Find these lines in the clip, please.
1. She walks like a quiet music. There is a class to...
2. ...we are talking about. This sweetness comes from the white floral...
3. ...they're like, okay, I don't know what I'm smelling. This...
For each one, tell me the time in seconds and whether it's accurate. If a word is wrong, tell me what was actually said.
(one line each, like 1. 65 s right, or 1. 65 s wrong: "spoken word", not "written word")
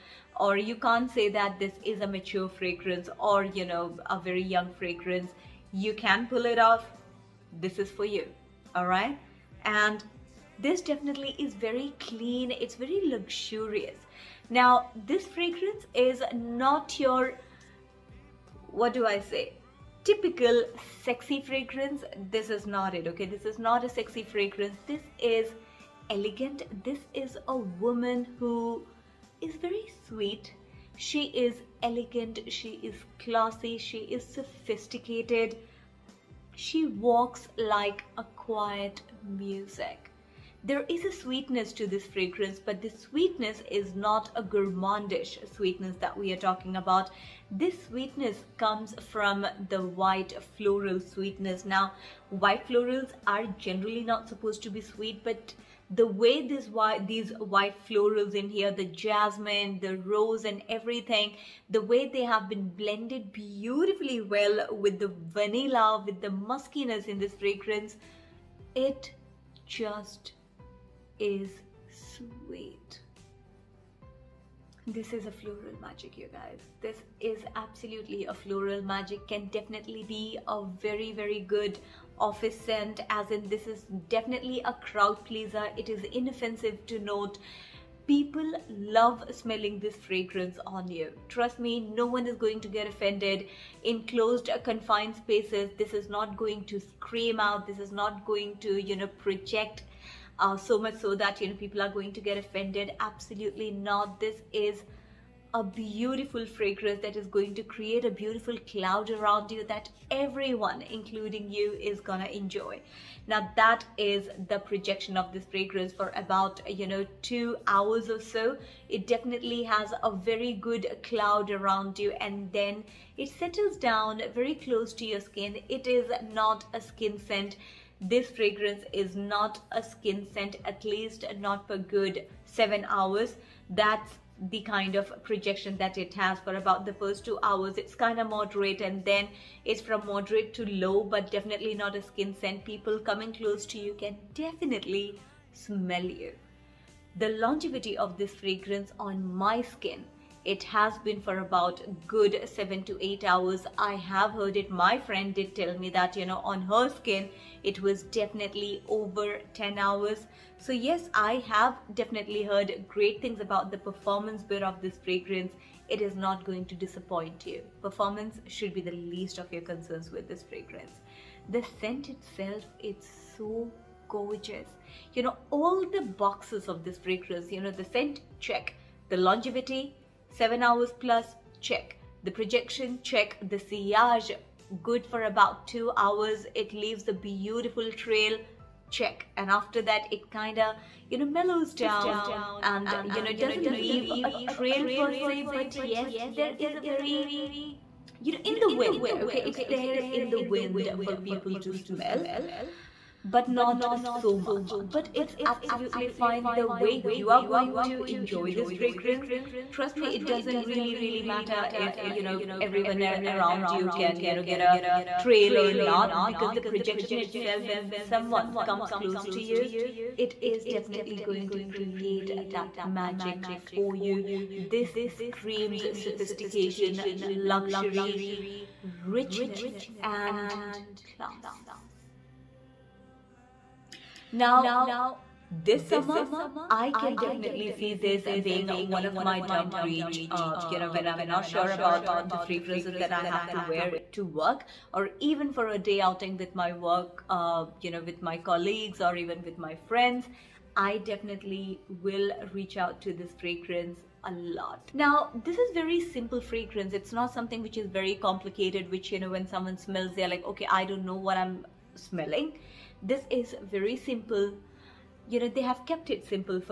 1. 36 s wrong: "sweetness", not "class"
2. 46 s right
3. 260 s right.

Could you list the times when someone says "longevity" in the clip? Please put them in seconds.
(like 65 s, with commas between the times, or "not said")
147 s, 179 s.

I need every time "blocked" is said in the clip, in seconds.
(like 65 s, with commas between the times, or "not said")
not said.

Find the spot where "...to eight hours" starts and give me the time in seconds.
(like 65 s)
152 s.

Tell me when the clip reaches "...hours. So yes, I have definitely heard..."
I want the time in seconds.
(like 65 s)
159 s.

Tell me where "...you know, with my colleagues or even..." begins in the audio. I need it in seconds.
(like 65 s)
247 s.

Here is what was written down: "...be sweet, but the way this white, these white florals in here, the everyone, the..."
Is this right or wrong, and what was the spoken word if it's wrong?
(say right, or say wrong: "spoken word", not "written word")
wrong: "jasmine", not "everyone".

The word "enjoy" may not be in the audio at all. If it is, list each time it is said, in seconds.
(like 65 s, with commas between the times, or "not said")
112 s, 208 s.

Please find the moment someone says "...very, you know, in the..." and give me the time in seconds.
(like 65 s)
196 s.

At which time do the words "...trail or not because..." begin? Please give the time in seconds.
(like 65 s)
215 s.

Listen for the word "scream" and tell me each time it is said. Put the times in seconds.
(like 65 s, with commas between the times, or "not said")
96 s, 225 s.